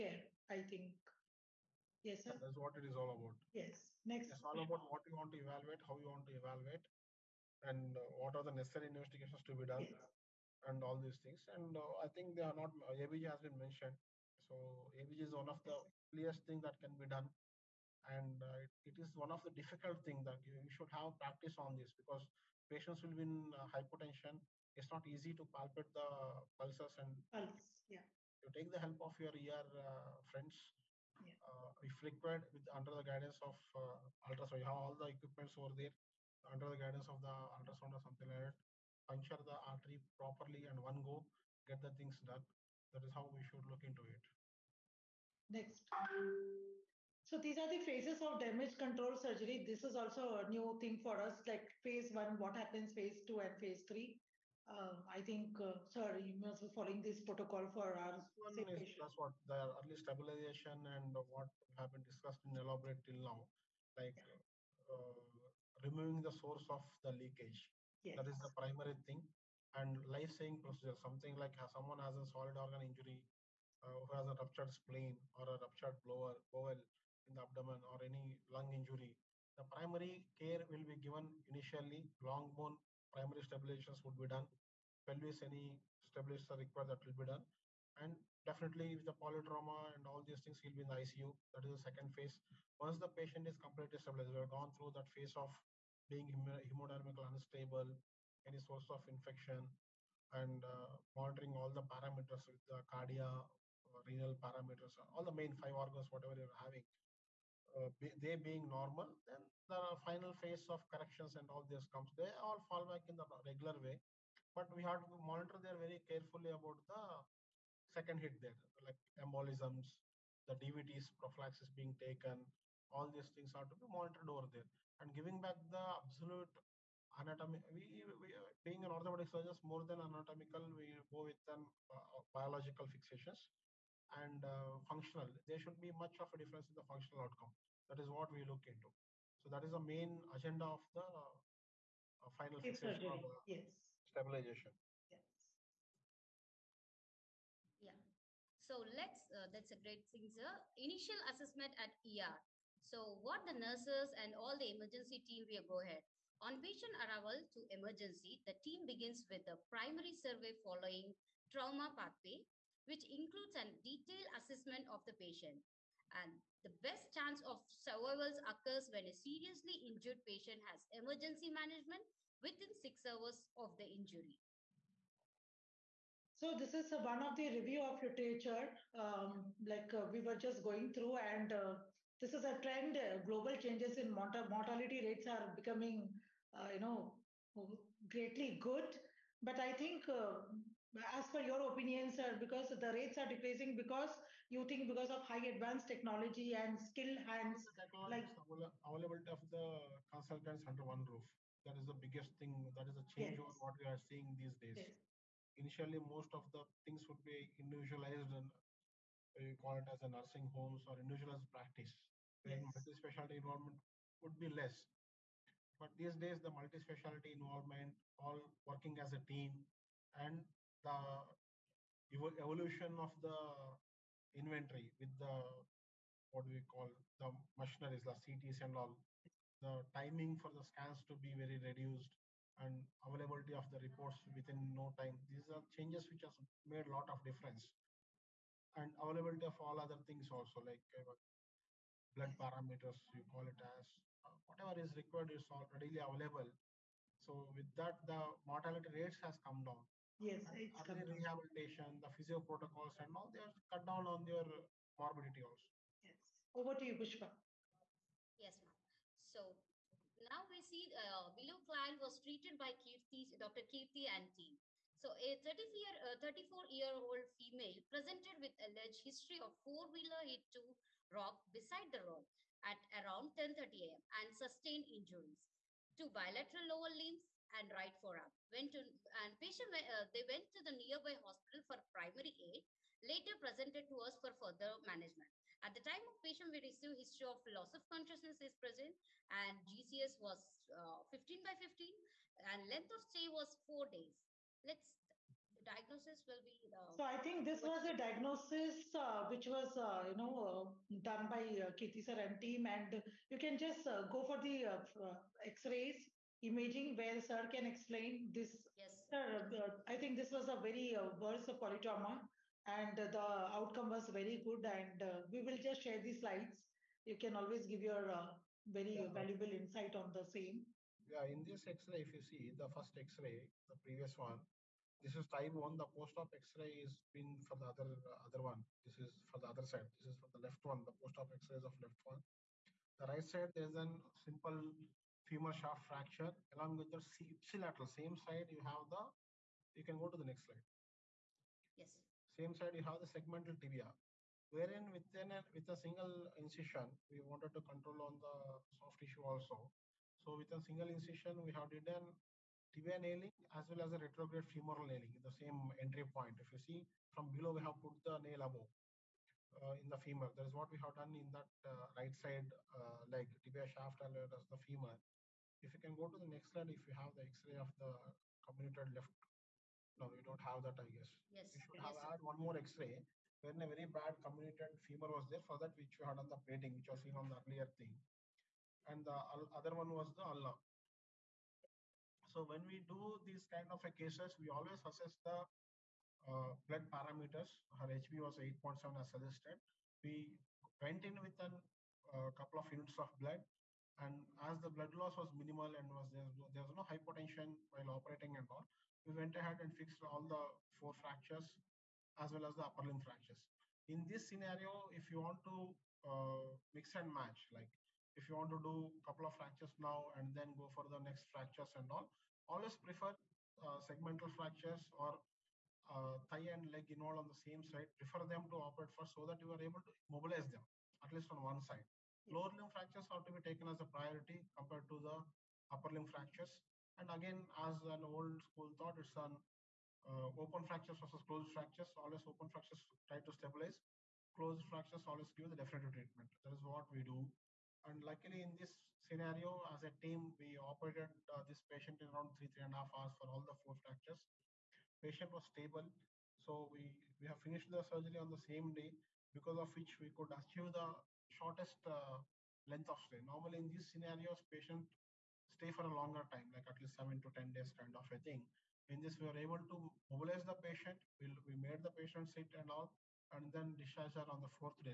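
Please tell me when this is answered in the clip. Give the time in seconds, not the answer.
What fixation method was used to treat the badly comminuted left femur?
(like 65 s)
376 s.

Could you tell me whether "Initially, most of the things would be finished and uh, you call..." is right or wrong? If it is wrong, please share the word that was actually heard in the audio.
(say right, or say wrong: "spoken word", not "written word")
wrong: "individualized", not "finished".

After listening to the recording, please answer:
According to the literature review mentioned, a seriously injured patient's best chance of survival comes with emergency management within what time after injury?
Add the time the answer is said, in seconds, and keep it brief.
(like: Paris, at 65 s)
6 hours, at 172 s.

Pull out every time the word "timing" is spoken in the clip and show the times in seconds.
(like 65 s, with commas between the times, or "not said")
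229 s.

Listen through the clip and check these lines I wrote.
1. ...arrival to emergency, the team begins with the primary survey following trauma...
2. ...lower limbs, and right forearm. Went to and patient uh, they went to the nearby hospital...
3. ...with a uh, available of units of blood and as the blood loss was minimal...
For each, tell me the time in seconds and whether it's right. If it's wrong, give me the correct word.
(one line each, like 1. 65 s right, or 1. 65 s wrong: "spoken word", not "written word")
1. 156 s right
2. 276 s right
3. 391 s wrong: "couple", not "available".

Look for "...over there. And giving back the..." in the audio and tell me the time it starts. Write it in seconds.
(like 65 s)
124 s.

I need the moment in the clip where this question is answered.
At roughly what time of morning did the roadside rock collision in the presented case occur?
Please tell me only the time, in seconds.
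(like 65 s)
273 s.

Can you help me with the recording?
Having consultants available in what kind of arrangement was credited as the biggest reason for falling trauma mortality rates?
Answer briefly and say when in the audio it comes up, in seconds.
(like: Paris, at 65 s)
Under one roof, at 200 s.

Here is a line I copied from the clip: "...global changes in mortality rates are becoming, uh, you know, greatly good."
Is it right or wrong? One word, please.
right.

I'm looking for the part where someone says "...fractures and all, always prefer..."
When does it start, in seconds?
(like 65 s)
411 s.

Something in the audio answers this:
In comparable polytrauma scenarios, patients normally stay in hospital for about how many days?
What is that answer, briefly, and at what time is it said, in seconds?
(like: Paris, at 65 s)
7 to 10 days, at 456 s.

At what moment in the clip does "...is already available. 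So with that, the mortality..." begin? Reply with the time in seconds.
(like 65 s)
245 s.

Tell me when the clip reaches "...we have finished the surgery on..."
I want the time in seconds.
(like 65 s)
447 s.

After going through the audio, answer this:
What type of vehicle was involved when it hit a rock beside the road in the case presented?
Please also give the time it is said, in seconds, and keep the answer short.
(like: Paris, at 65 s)
Four-wheeler, at 269 s.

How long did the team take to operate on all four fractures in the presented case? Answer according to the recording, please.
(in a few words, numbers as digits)
3.5 hours.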